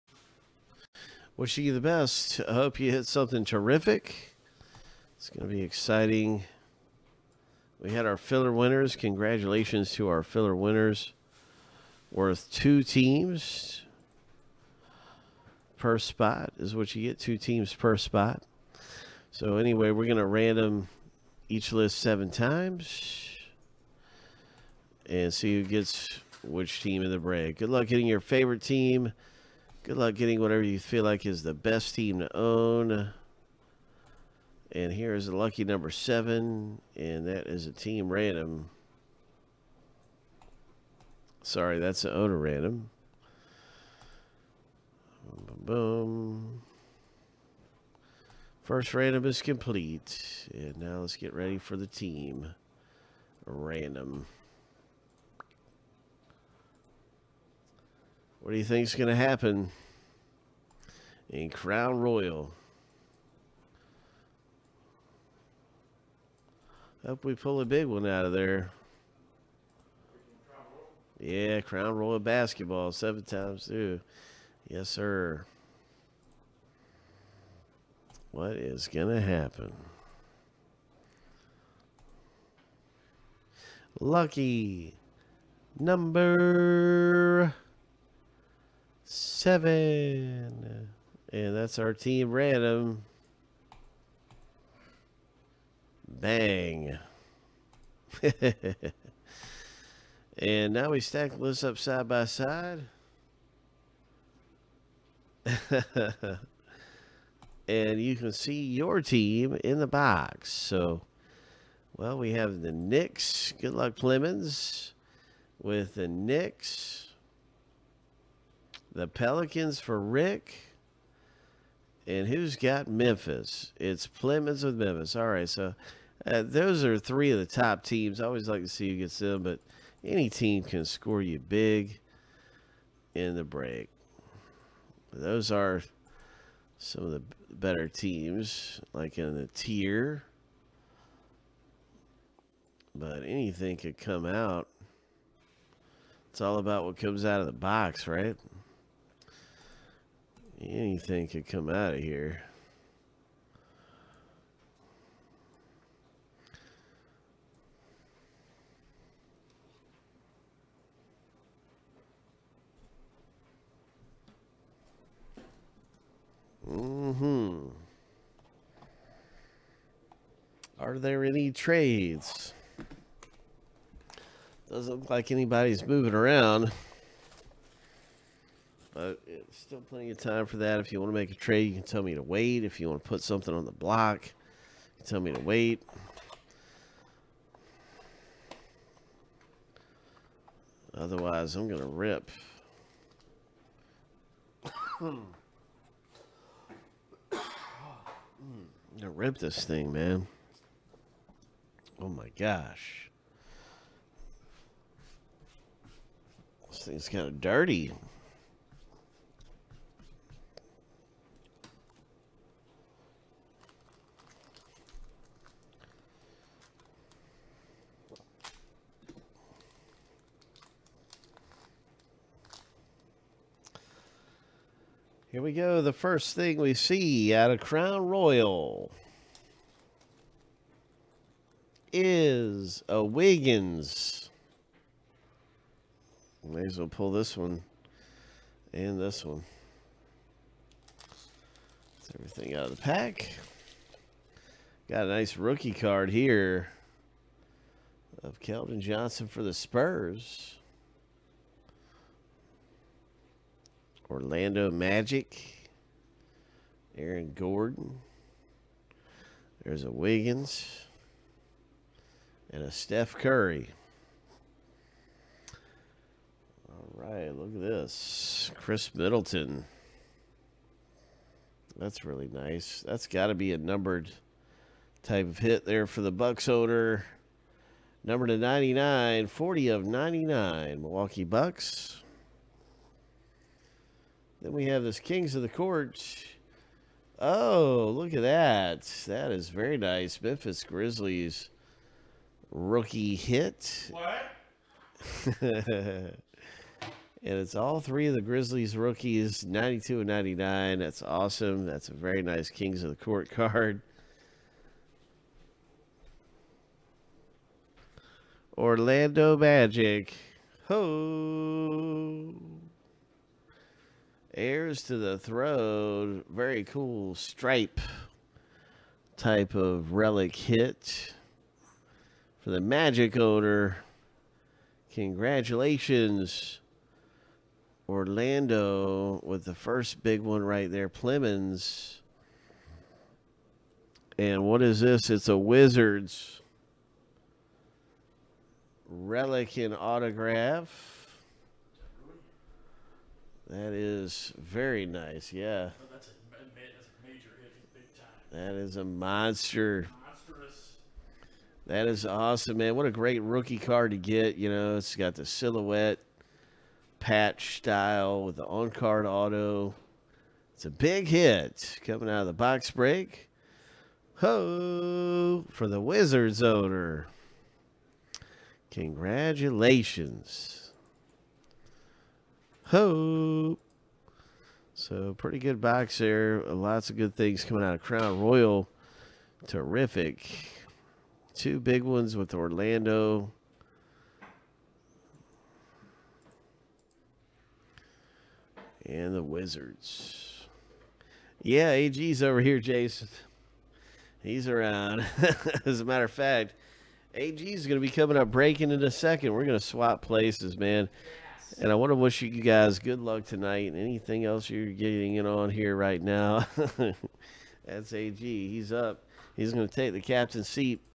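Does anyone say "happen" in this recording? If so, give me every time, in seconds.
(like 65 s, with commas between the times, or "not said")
59 s, 79 s.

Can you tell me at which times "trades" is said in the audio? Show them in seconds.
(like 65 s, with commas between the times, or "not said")
171 s, 181 s.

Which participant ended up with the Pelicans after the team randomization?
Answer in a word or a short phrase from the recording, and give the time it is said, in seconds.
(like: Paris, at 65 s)
Rick, at 119 s.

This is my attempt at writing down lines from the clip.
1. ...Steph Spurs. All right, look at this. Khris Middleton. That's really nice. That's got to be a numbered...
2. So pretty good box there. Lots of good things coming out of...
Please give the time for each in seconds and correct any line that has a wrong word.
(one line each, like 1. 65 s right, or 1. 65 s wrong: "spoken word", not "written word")
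1. 262 s wrong: "Curry", not "Spurs"
2. 374 s right.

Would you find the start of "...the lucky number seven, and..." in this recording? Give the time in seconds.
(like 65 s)
35 s.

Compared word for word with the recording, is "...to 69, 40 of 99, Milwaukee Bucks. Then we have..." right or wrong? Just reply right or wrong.
wrong.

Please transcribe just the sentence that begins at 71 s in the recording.
Yeah, Crown Royale basketball seven times two.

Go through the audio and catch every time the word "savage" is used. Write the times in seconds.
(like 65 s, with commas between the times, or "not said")
not said.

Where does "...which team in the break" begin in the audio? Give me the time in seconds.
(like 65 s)
26 s.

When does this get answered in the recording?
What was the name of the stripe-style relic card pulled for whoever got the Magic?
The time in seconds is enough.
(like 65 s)
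314 s.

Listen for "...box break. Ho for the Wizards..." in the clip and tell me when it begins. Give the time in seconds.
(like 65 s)
362 s.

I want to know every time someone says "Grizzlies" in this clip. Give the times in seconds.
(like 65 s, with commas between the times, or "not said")
290 s, 298 s.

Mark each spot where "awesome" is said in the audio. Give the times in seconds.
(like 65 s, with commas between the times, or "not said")
301 s, 352 s.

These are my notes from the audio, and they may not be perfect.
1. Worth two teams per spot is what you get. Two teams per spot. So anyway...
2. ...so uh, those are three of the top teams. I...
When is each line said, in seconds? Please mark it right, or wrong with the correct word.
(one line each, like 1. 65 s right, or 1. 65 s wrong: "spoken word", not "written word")
1. 12 s right
2. 125 s right.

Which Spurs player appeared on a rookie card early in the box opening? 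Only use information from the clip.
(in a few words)
Keldon Johnson.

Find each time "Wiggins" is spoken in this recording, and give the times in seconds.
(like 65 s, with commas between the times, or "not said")
233 s, 259 s.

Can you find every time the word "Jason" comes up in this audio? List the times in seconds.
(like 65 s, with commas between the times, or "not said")
392 s.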